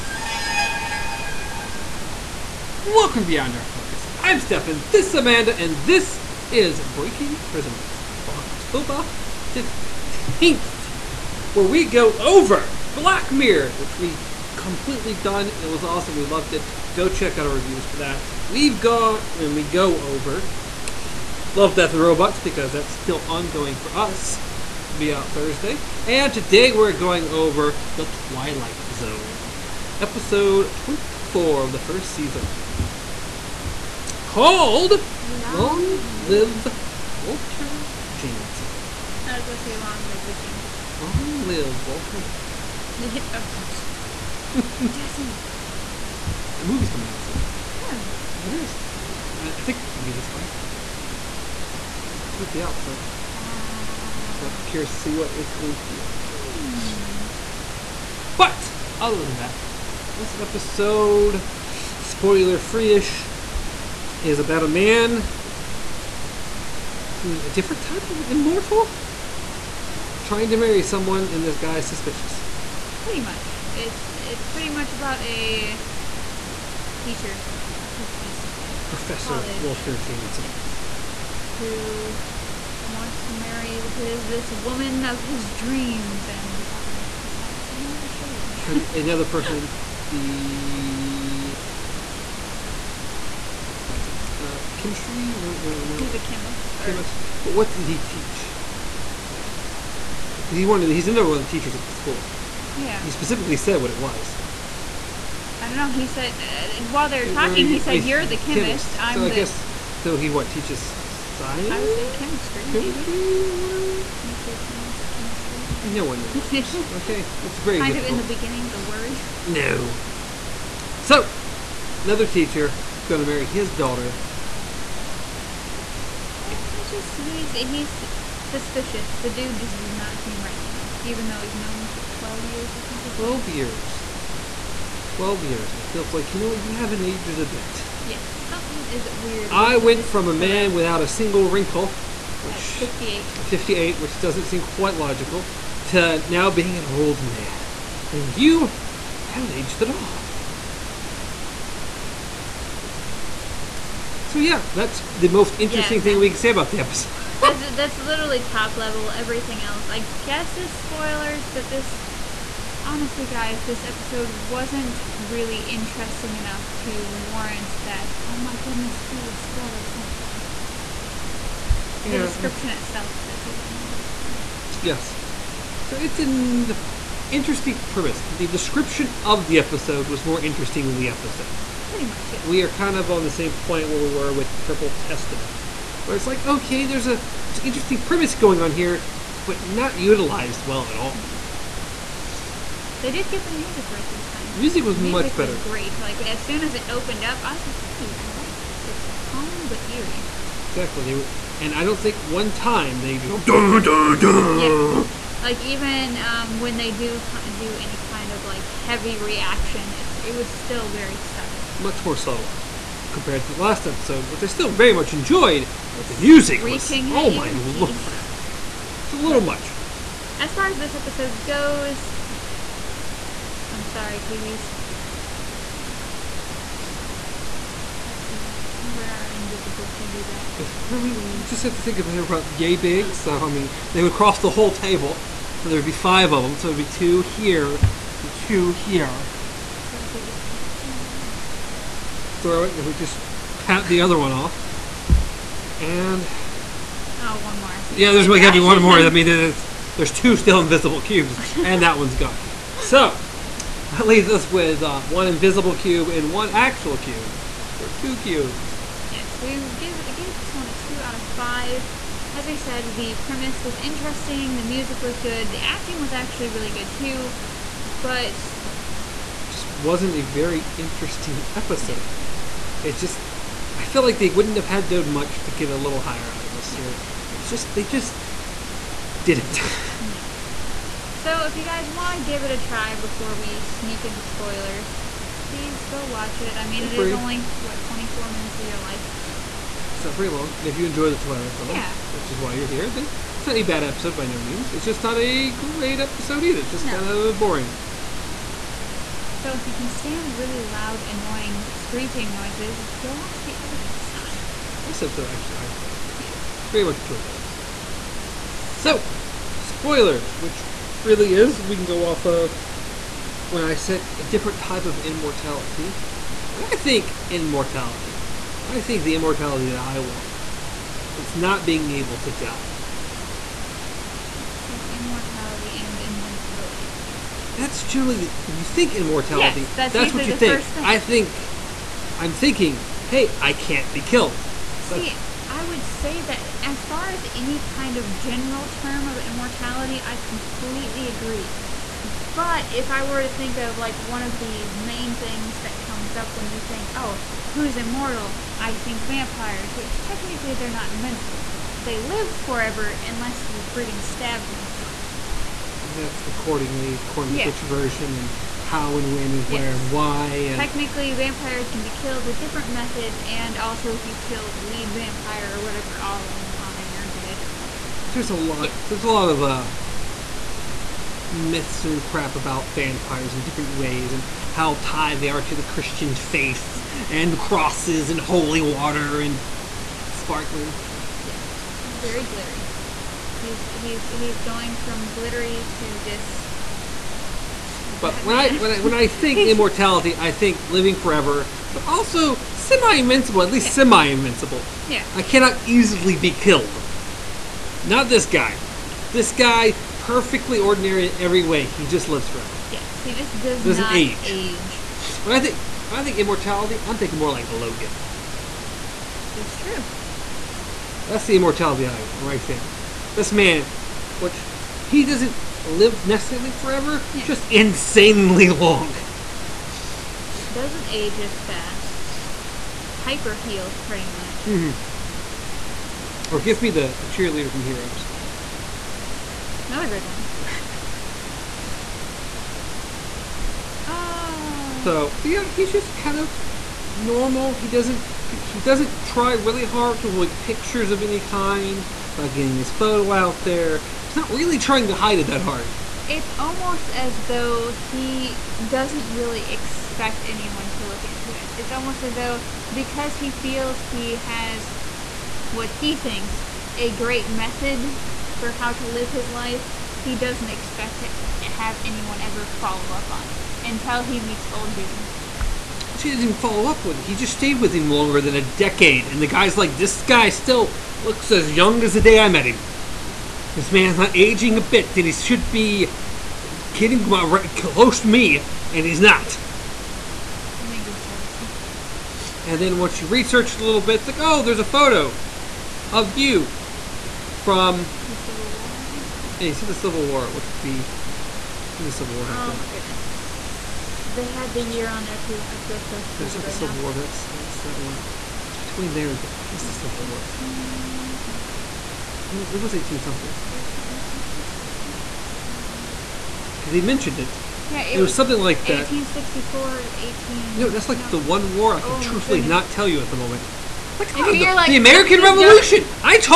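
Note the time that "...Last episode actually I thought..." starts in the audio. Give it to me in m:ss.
5:04.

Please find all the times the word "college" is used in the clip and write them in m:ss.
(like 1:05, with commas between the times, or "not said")
1:19.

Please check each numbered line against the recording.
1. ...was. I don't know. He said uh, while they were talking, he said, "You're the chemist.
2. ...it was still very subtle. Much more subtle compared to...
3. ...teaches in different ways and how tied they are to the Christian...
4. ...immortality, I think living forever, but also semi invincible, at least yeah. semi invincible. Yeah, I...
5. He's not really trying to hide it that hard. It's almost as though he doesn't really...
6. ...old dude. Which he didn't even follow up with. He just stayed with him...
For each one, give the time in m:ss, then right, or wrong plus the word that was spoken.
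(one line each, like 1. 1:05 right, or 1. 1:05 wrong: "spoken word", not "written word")
1. 1:43 right
2. 3:30 right
3. 6:12 wrong: "vampires", not "teaches"
4. 6:29 right
5. 7:24 right
6. 7:44 right.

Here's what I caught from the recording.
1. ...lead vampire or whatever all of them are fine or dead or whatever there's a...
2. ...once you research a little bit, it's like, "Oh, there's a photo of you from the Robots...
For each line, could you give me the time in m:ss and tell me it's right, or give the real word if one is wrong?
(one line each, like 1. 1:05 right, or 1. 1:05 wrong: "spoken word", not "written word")
1. 6:04 right
2. 8:02 wrong: "Civil", not "Robots".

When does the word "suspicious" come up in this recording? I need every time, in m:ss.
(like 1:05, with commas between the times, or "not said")
1:11, 2:08.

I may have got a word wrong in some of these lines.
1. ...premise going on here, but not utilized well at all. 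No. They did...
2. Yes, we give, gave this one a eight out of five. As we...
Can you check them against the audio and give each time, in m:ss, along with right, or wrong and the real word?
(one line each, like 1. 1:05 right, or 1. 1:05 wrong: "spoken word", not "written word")
1. 3:08 right
2. 4:19 wrong: "two", not "eight".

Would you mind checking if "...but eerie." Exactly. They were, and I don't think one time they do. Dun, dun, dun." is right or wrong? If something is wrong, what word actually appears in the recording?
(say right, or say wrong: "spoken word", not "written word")
right.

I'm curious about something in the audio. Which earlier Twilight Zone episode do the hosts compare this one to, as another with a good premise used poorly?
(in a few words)
Purple Testament.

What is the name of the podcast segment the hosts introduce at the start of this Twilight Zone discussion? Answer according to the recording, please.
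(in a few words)
Breaking Prisms.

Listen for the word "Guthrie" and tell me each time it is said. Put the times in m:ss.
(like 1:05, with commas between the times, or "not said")
not said.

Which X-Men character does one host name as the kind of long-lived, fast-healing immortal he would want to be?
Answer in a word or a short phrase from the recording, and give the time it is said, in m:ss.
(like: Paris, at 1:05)
Logan, at 6:47.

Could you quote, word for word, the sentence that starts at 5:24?
So immortality and invincibility, pretty much.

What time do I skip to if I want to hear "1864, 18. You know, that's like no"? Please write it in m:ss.
8:28.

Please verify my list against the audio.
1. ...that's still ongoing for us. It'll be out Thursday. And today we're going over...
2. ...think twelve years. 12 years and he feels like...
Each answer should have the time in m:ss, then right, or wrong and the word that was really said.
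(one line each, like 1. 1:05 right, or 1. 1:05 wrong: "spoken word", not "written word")
1. 0:22 right
2. 2:12 right.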